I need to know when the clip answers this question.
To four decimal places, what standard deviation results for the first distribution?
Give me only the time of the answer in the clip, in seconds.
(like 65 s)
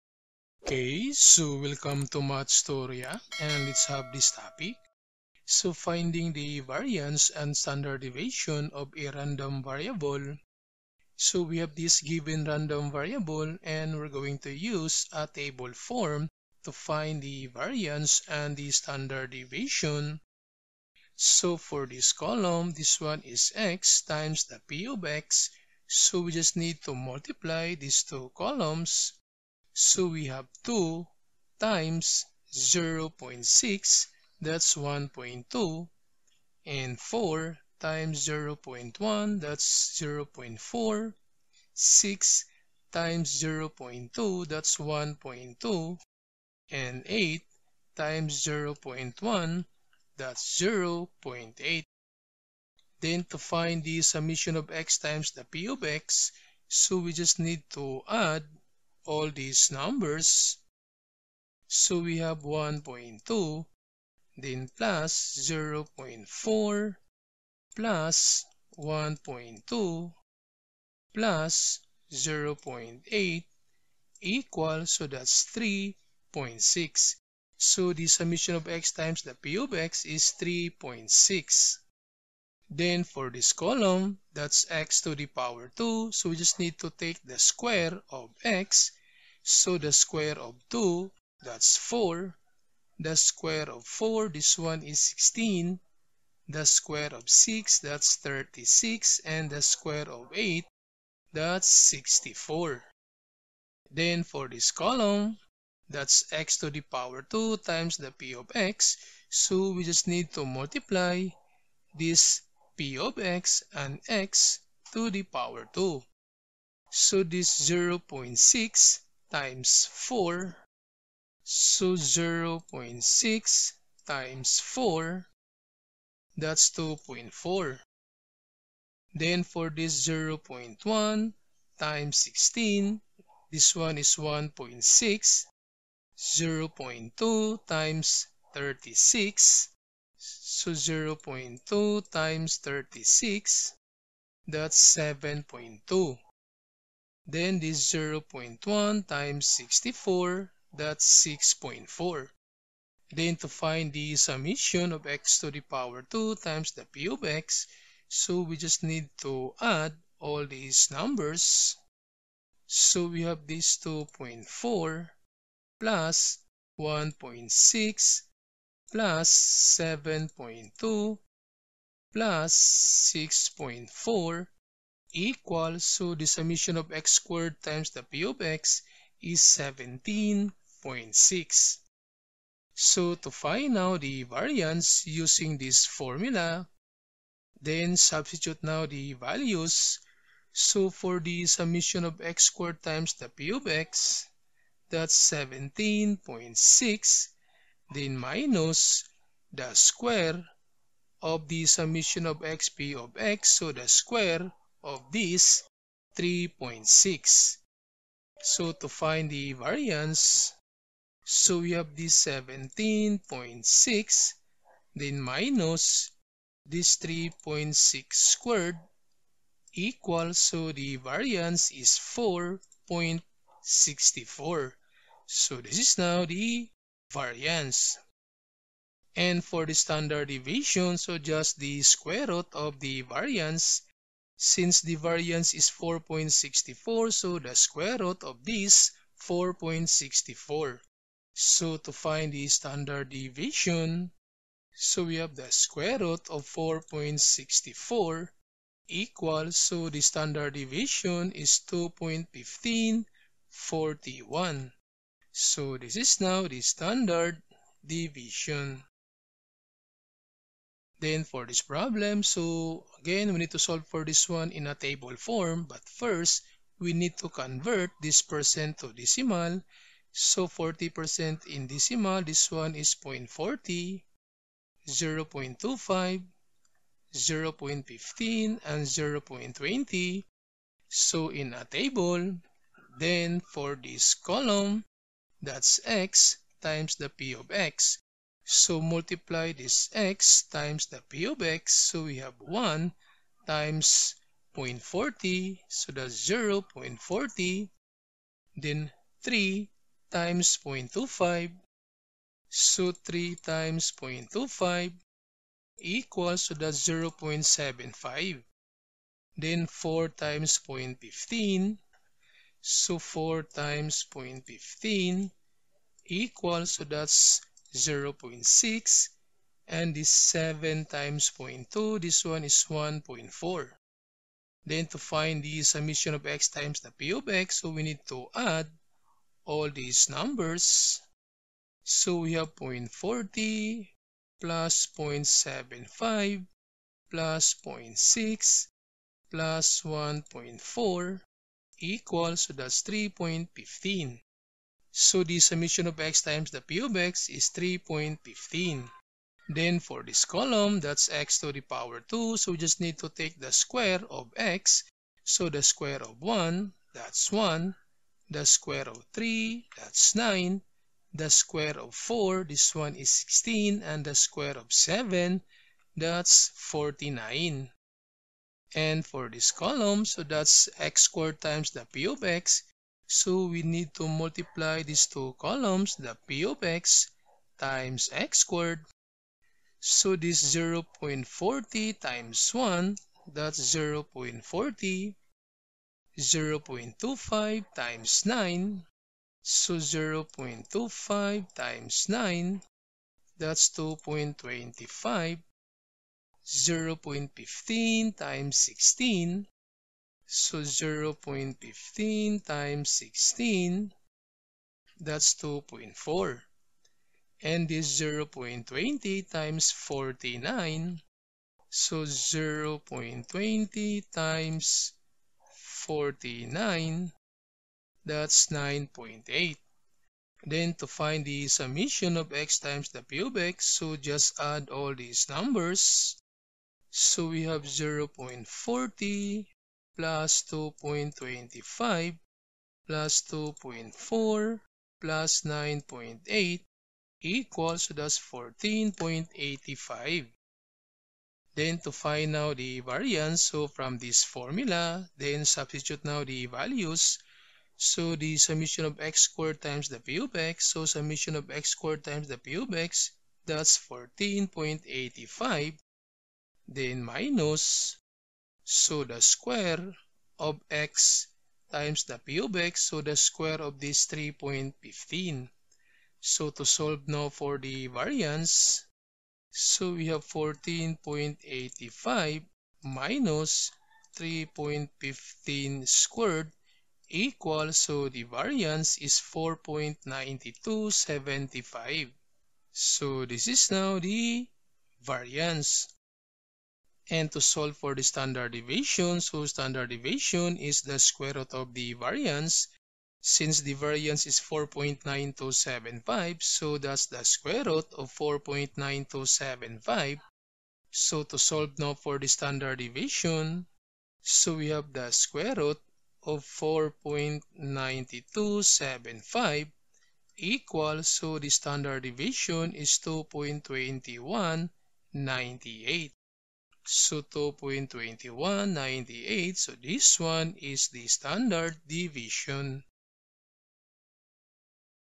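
251 s.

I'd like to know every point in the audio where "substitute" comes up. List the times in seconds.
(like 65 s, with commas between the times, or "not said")
187 s, 445 s.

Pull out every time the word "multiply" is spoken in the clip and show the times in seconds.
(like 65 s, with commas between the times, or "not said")
26 s, 110 s, 288 s, 374 s.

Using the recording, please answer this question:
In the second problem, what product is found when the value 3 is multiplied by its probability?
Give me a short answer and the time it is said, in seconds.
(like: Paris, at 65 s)
0.75, at 306 s.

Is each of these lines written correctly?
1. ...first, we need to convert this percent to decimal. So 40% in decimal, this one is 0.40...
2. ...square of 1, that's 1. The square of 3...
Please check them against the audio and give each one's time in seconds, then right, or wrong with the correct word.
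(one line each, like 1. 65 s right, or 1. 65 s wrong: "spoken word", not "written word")
1. 265 s right
2. 355 s right.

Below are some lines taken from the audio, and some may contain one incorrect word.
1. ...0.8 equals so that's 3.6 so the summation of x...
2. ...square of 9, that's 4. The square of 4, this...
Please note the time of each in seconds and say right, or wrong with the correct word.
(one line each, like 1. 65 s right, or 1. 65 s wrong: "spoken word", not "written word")
1. 72 s right
2. 89 s wrong: "2", not "9".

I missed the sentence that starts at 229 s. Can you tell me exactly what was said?
And for the standard deviation, so just the square root of the variance.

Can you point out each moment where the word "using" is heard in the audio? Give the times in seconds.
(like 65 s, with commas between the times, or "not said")
185 s.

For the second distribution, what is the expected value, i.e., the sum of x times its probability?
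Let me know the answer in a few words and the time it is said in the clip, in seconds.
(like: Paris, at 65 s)
3.15, at 342 s.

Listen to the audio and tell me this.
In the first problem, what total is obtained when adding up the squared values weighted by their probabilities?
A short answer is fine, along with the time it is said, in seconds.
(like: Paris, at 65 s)
17.6, at 179 s.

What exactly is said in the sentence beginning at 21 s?
So for this column, this one is x times the p of x.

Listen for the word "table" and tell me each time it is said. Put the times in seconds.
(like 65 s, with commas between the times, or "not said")
15 s, 264 s, 281 s.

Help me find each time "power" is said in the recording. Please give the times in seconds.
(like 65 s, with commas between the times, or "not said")
85 s, 106 s, 155 s, 351 s.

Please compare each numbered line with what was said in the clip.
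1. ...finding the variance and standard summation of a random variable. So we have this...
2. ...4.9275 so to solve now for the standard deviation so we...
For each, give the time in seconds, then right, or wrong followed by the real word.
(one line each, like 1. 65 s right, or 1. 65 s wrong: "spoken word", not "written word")
1. 5 s wrong: "deviation", not "summation"
2. 498 s right.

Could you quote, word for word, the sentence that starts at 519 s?
So this one is the standard deviation.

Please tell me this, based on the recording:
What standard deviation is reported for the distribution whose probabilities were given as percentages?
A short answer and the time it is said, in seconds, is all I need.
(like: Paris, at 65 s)
2.2198, at 511 s.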